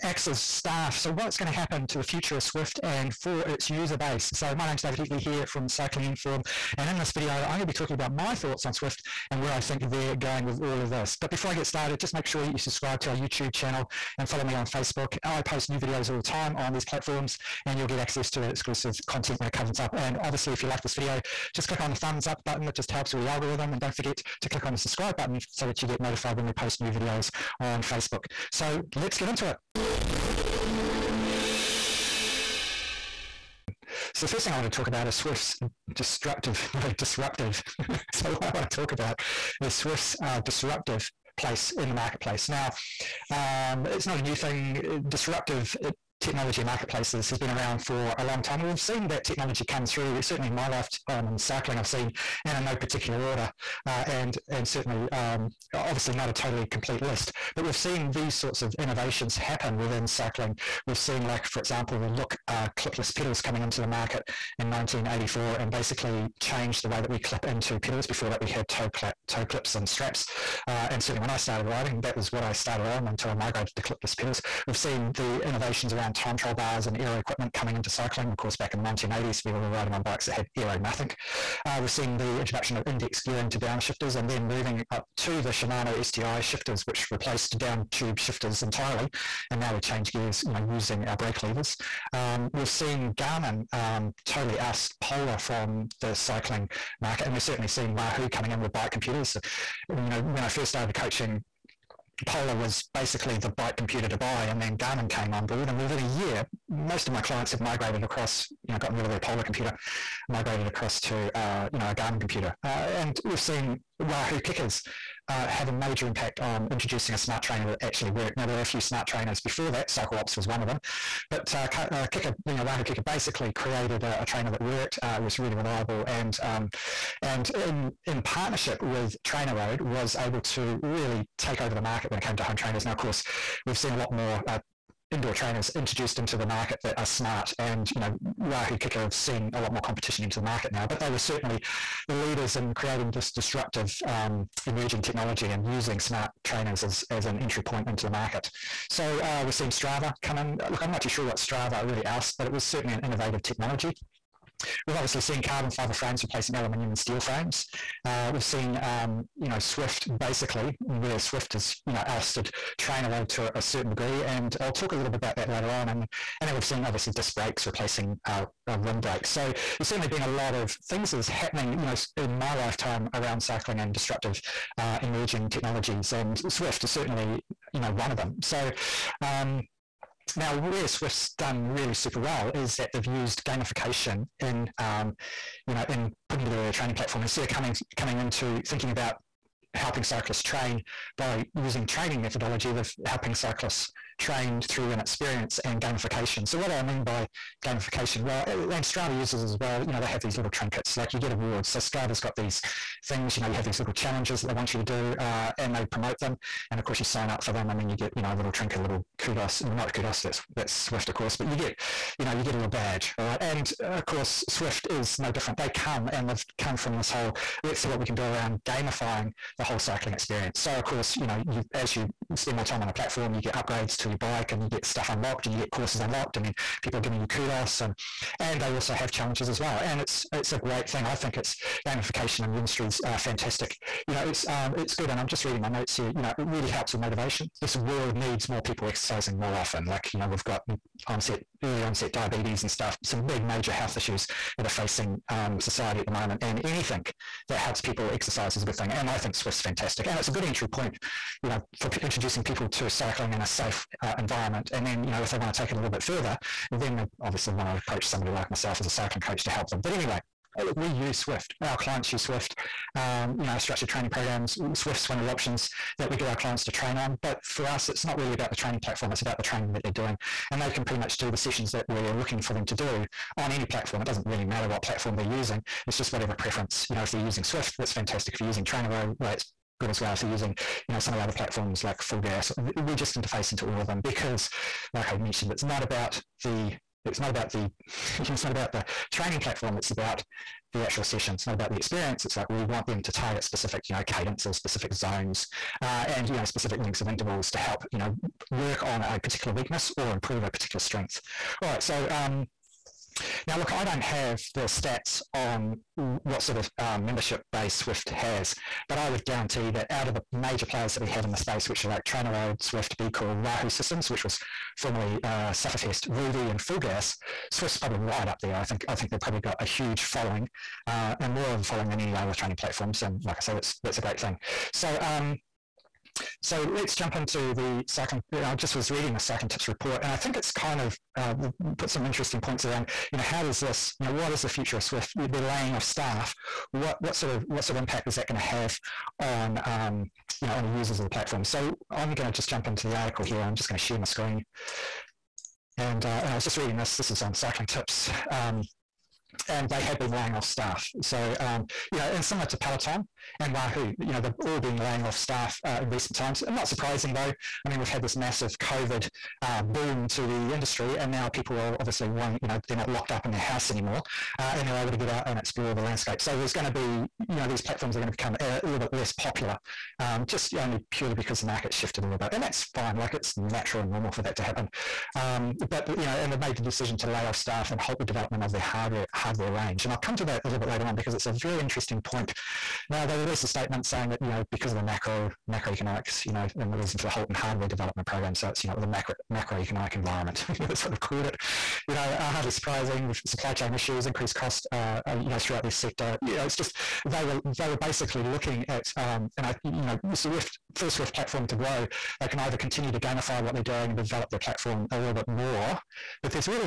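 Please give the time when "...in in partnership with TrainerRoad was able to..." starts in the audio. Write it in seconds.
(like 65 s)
127 s.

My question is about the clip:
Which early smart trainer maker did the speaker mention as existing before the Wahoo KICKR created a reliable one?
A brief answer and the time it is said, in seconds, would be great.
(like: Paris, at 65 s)
CycleOps, at 119 s.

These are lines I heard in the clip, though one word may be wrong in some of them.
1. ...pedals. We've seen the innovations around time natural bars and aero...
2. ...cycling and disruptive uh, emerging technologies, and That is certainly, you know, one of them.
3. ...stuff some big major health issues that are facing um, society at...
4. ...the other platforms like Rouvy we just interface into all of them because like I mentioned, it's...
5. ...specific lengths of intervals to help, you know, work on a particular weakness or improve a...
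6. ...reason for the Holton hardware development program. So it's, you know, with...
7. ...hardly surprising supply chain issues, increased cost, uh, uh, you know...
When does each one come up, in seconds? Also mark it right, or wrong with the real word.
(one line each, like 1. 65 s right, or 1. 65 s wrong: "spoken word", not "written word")
1. 74 s wrong: "trial", not "natural"
2. 173 s wrong: "Zwift", not "That"
3. 242 s right
4. 281 s wrong: "FulGaz", not "Rouvy"
5. 296 s right
6. 386 s right
7. 392 s right.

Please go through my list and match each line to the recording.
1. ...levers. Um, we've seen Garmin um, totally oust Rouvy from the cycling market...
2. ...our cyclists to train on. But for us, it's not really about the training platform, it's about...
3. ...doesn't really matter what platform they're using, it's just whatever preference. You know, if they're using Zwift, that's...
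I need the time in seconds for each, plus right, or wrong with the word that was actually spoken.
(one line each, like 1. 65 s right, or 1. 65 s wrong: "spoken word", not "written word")
1. 91 s wrong: "Polar", not "Rouvy"
2. 266 s wrong: "clients", not "cyclists"
3. 274 s right.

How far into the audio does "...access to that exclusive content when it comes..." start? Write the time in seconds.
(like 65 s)
17 s.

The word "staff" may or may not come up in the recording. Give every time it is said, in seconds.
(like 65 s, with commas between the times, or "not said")
0 s, 335 s, 350 s, 355 s, 377 s.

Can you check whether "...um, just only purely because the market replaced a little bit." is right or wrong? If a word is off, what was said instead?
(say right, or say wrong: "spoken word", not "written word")
wrong: "shifted", not "replaced".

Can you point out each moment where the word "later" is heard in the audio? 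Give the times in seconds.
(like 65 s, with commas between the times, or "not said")
165 s, 380 s.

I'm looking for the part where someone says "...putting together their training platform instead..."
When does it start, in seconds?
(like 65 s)
186 s.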